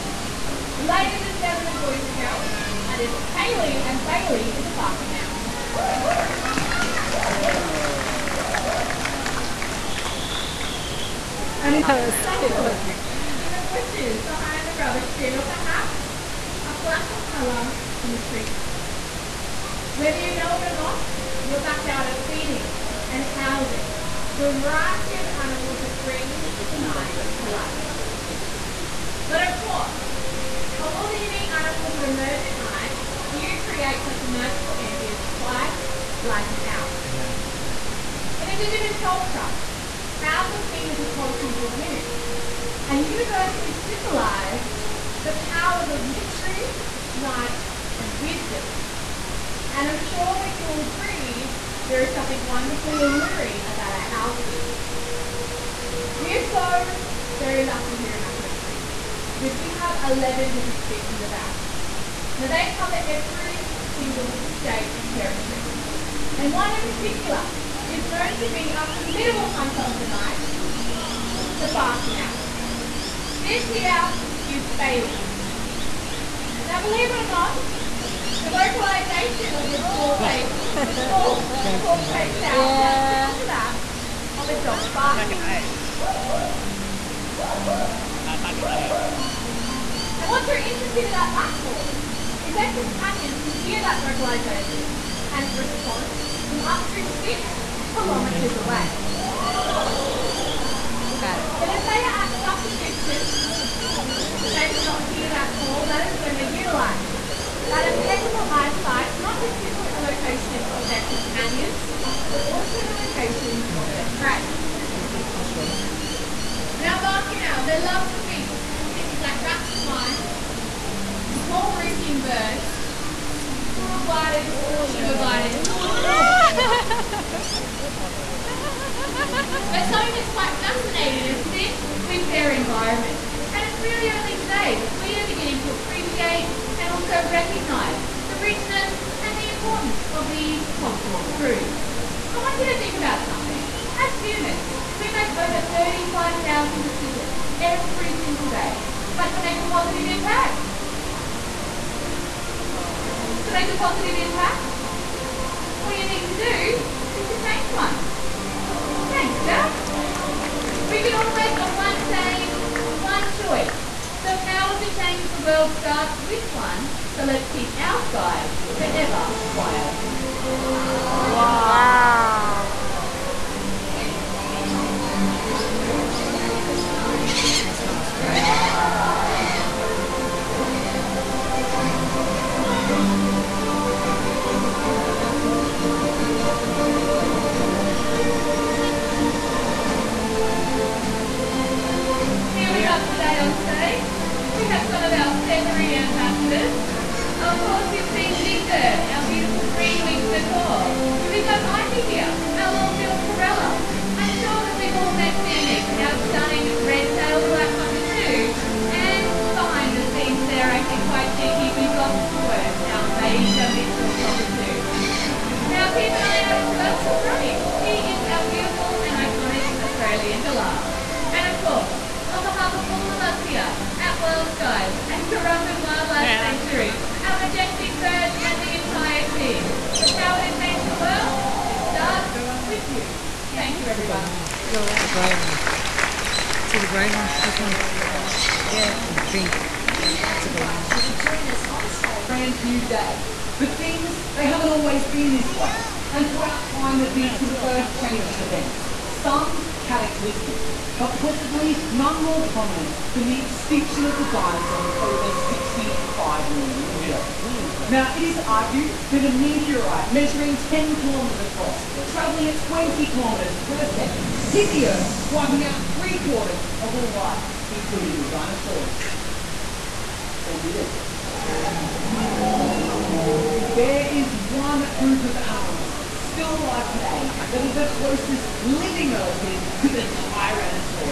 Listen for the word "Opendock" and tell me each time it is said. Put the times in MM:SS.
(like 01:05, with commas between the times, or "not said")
not said.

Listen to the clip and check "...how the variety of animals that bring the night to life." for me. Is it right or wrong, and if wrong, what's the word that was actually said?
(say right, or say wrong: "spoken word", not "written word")
right.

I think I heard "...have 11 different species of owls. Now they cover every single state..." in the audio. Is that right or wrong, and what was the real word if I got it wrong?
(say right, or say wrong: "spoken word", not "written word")
right.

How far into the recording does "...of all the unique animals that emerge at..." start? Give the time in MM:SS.
00:30.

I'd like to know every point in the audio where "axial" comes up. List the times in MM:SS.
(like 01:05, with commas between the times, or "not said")
not said.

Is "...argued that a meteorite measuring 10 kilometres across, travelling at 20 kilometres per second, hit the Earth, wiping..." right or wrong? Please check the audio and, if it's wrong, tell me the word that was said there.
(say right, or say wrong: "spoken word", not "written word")
right.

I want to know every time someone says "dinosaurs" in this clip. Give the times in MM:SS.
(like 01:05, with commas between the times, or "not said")
04:14, 04:28.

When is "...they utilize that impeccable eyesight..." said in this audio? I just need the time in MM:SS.
01:46.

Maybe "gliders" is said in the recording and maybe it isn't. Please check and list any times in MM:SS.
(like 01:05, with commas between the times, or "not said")
02:04, 02:08.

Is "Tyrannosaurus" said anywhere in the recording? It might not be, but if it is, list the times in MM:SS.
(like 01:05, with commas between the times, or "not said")
04:40.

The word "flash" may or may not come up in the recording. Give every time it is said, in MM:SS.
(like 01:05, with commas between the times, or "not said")
00:16.